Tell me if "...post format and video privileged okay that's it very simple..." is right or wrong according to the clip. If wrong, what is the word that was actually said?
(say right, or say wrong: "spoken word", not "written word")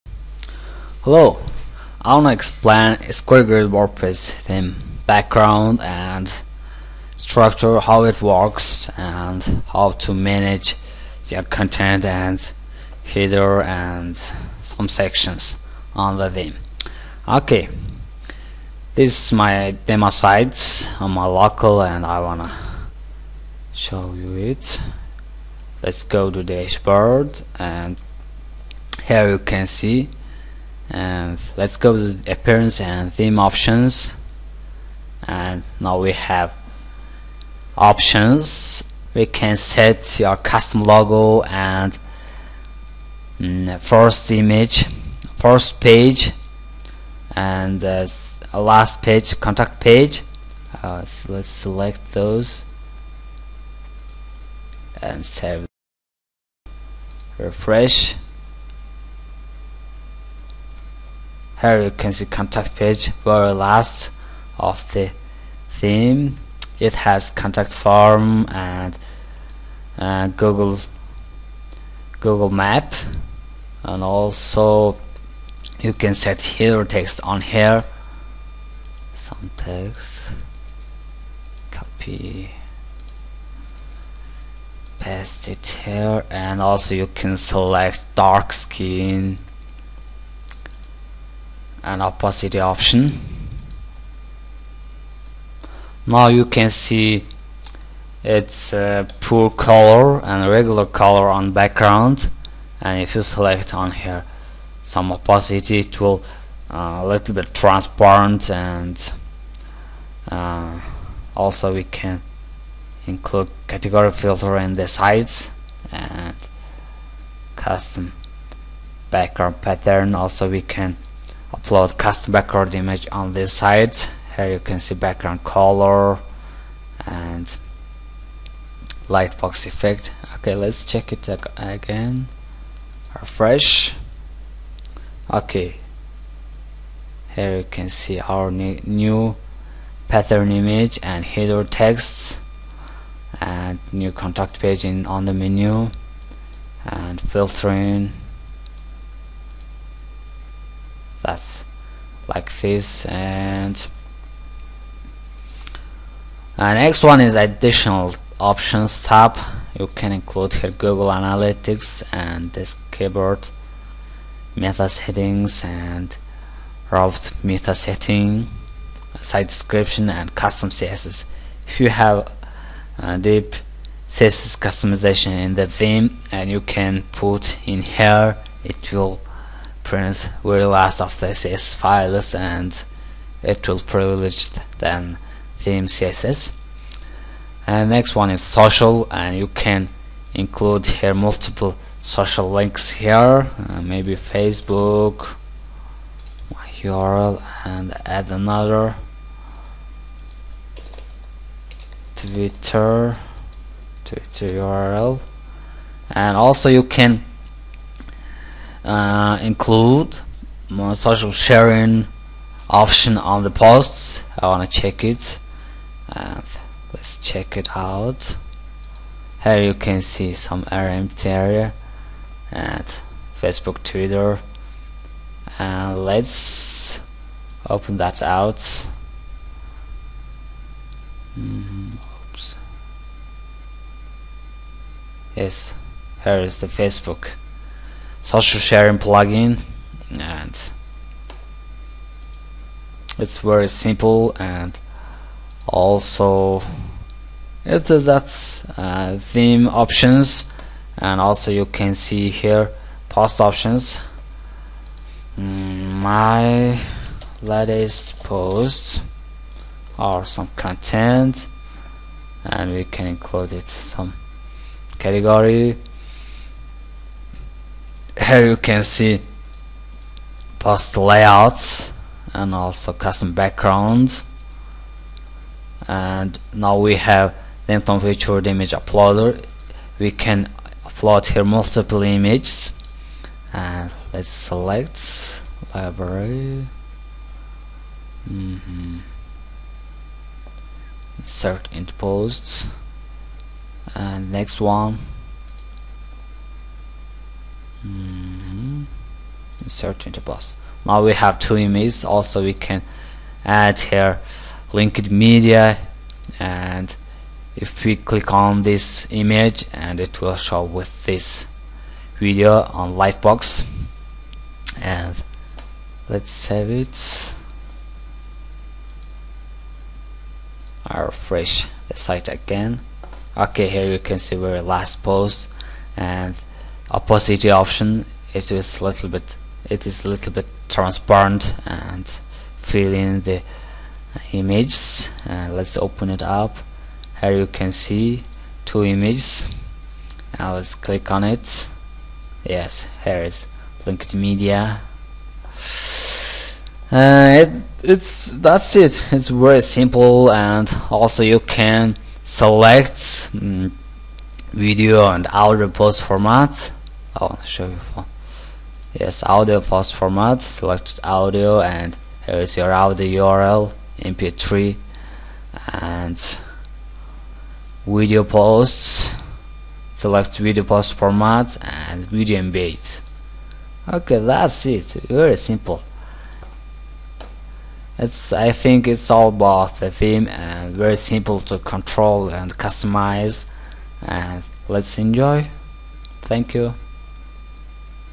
wrong: "embed", not "privileged".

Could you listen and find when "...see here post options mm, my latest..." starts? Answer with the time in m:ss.
4:11.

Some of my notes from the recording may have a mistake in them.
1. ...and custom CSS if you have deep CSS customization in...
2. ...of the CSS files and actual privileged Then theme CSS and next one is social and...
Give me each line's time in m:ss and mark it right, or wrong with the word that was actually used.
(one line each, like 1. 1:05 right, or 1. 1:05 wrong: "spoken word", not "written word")
1. 2:50 right
2. 3:01 right.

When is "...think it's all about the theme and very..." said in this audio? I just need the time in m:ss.
6:18.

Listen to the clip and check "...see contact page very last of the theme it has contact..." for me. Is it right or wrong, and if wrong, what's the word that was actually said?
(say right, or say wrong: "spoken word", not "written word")
right.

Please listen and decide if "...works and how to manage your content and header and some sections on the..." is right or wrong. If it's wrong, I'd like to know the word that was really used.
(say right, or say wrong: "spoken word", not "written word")
right.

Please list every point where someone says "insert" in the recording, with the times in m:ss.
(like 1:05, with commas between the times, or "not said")
4:51, 4:59.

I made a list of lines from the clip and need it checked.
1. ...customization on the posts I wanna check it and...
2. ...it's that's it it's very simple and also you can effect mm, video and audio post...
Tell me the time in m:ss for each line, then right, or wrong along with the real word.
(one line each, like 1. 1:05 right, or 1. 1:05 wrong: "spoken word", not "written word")
1. 3:32 wrong: "option", not "customization"
2. 5:47 wrong: "select", not "effect".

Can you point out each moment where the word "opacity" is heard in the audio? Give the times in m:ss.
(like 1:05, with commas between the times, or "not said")
1:32, 1:45, 5:26.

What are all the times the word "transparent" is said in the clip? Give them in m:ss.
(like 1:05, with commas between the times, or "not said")
1:47, 5:30.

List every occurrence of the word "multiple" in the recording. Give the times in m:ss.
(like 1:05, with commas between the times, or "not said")
3:11, 4:41.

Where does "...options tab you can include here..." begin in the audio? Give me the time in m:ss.
2:38.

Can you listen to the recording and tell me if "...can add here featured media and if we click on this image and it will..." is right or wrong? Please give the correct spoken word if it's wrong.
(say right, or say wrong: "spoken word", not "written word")
wrong: "linked", not "featured".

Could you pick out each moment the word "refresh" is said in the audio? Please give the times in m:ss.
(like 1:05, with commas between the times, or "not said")
0:57, 2:13, 5:21.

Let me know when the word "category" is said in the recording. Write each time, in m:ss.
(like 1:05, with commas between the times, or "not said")
1:53, 4:24.